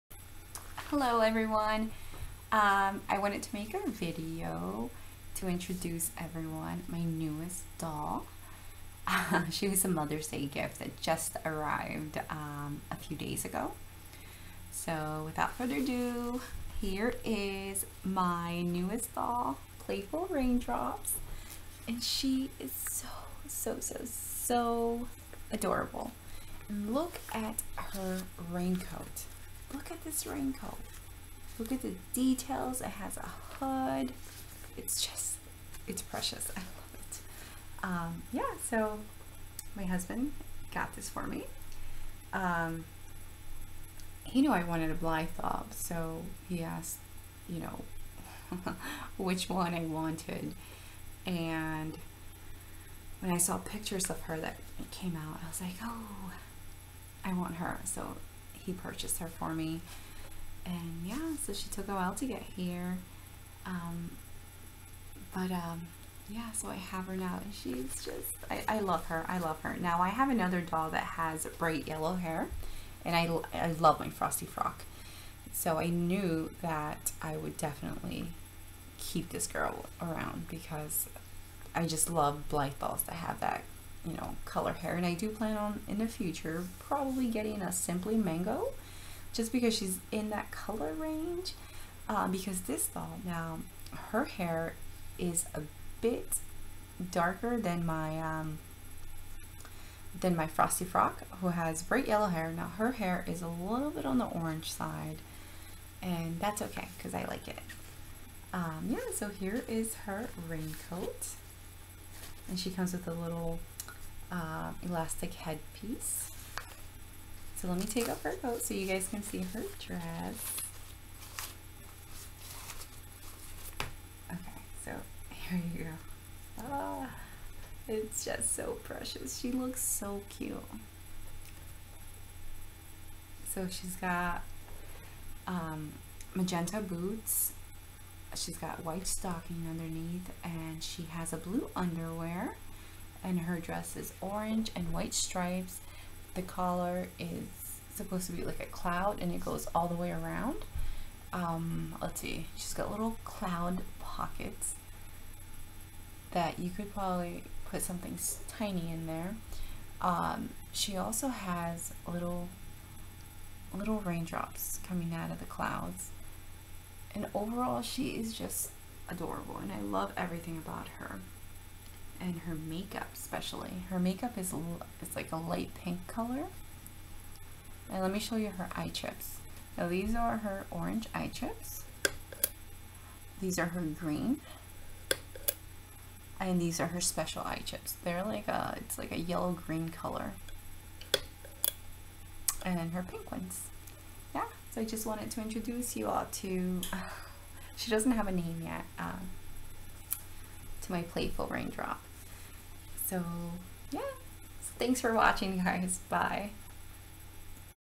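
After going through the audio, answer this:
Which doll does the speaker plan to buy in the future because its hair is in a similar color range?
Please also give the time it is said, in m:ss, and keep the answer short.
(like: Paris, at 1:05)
Simply Mango, at 1:27.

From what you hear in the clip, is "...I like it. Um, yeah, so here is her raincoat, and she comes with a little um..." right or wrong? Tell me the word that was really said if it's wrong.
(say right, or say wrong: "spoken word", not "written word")
right.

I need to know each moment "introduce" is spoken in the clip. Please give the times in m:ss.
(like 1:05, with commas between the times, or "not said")
0:05, 3:15.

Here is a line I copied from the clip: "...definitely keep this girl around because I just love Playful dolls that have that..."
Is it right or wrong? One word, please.
wrong.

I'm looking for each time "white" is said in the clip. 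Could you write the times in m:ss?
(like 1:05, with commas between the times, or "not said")
2:18, 2:24.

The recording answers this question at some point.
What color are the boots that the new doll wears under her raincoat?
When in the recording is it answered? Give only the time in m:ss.
2:16.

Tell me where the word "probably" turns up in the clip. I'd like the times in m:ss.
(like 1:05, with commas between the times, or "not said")
1:26, 2:36.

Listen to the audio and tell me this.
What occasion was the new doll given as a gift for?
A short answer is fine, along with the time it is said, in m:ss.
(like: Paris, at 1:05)
Mother's Day, at 0:09.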